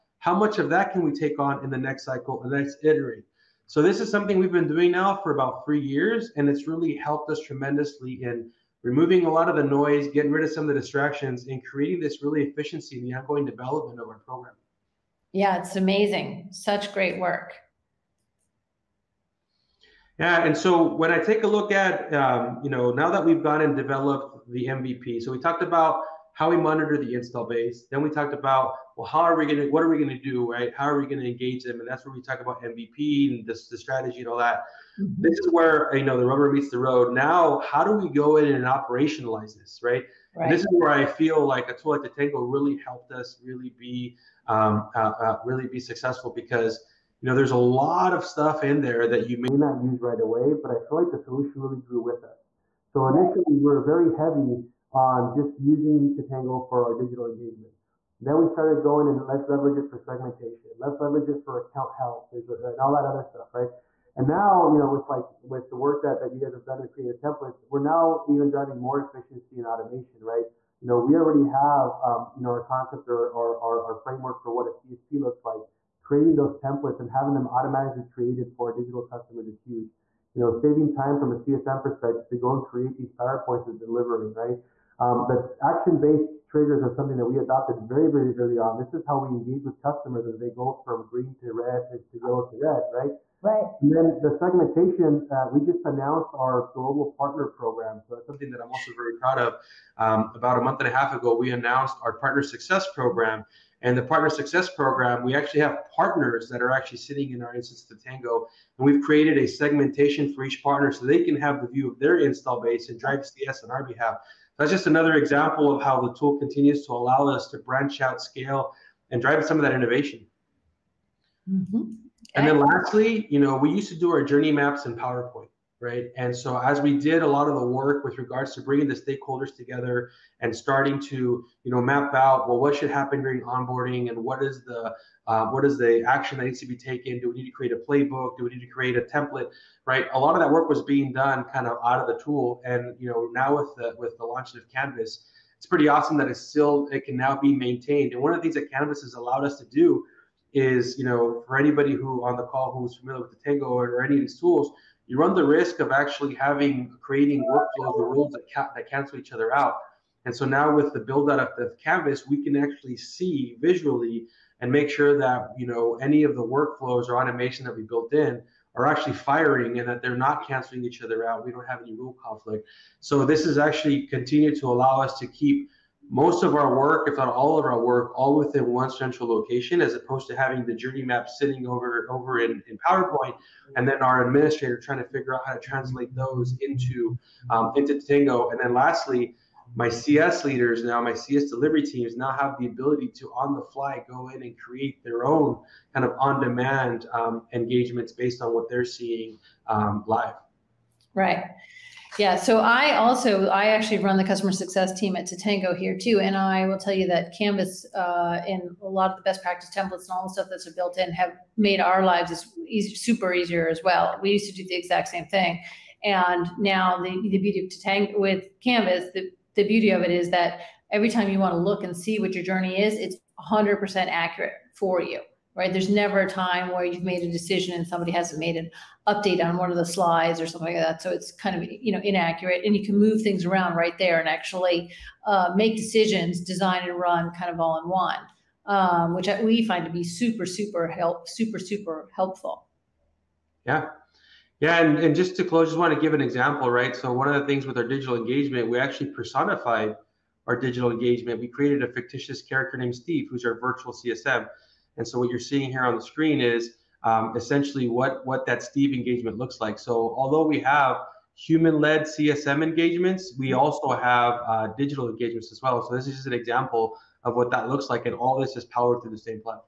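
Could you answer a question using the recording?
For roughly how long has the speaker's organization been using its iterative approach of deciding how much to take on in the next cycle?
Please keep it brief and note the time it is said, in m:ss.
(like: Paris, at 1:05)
3 years, at 0:05.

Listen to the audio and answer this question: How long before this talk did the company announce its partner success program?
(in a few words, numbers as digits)
a month and a half.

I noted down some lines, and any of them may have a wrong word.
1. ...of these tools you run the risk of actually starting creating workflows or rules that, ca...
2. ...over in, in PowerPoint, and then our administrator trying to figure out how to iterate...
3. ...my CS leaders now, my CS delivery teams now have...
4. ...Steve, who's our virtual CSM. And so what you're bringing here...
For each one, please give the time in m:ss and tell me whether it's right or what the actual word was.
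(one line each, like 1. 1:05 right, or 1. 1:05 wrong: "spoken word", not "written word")
1. 2:34 wrong: "having", not "starting"
2. 3:02 wrong: "translate", not "iterate"
3. 3:09 right
4. 4:12 wrong: "seeing", not "bringing".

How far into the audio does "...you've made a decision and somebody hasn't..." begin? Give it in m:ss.
3:46.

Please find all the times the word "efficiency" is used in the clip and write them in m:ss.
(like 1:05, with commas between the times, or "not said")
0:12, 1:09.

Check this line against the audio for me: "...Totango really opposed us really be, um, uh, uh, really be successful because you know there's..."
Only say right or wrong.
wrong.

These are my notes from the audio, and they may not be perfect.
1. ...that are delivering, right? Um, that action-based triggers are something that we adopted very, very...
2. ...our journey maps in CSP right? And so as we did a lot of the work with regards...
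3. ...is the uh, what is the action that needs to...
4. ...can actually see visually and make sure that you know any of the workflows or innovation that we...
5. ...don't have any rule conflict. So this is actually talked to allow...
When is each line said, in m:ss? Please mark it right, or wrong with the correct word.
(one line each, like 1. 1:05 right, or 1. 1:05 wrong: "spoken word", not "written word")
1. 1:23 right
2. 2:04 wrong: "PowerPoint", not "CSP"
3. 2:14 right
4. 2:42 wrong: "automation", not "innovation"
5. 2:51 wrong: "continued", not "talked".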